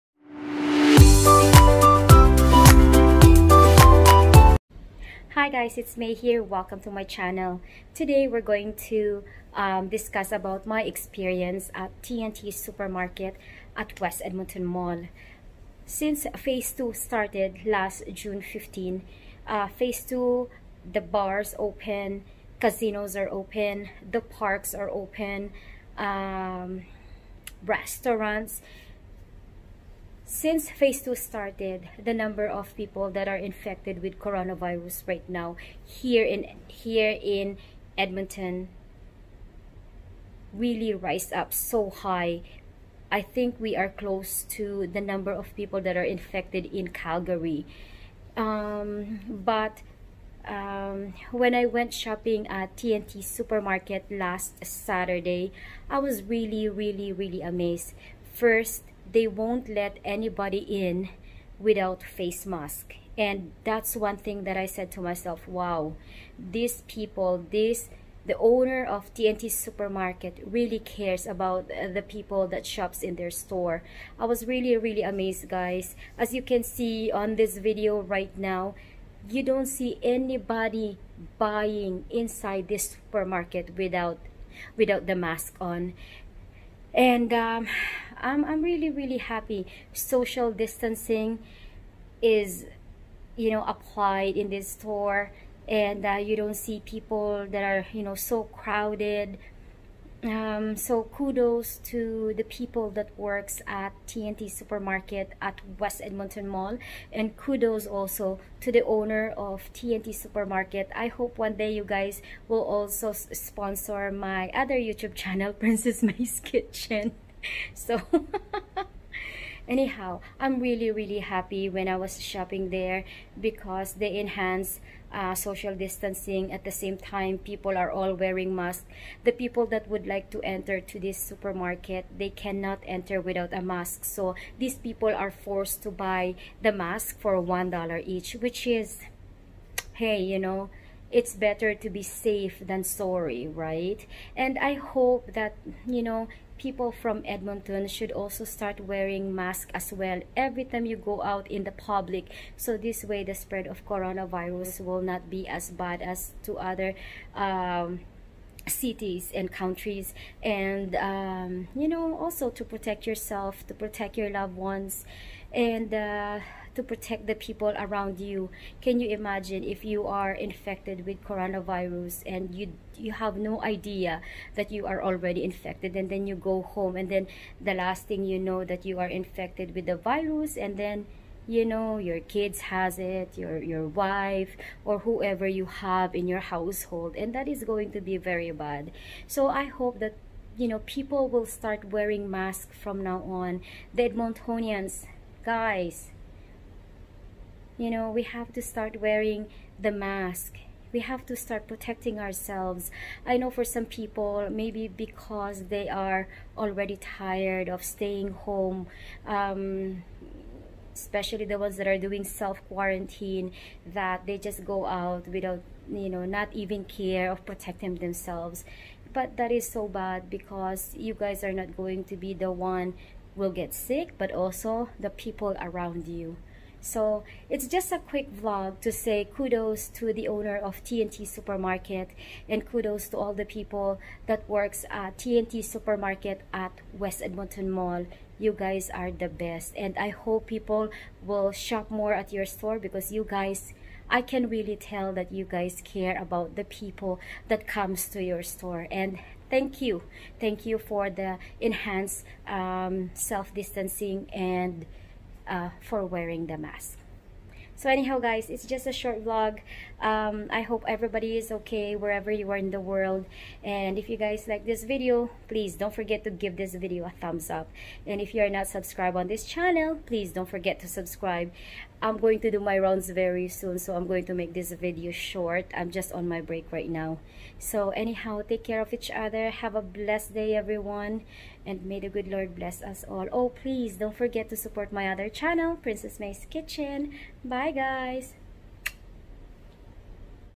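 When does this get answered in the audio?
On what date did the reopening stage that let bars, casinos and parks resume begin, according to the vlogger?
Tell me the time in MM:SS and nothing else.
00:18.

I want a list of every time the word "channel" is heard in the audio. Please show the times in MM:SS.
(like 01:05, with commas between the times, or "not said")
00:07, 01:55, 04:29, 04:45.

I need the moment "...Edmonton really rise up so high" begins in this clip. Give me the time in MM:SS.
00:37.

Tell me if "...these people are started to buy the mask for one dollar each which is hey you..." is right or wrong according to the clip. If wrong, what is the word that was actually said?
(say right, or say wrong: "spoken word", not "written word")
wrong: "forced", not "started".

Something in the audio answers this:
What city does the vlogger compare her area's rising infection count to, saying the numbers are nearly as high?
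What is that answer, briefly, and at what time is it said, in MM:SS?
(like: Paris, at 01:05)
Calgary, at 00:46.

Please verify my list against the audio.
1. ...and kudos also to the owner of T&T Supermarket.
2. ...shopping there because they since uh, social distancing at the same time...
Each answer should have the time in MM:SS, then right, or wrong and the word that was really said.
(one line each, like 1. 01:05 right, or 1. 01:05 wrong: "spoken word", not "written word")
1. 01:47 right
2. 02:02 wrong: "enhance", not "since".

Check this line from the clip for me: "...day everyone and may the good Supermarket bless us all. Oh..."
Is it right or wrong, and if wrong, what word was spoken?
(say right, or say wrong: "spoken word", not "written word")
wrong: "Lord", not "Supermarket".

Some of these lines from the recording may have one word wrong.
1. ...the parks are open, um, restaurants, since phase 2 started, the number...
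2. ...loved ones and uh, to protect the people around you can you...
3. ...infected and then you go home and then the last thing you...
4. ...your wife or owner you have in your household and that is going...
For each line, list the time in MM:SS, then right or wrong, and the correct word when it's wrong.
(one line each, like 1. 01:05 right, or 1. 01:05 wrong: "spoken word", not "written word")
1. 00:24 right
2. 02:44 right
3. 02:55 right
4. 03:03 wrong: "whoever", not "owner".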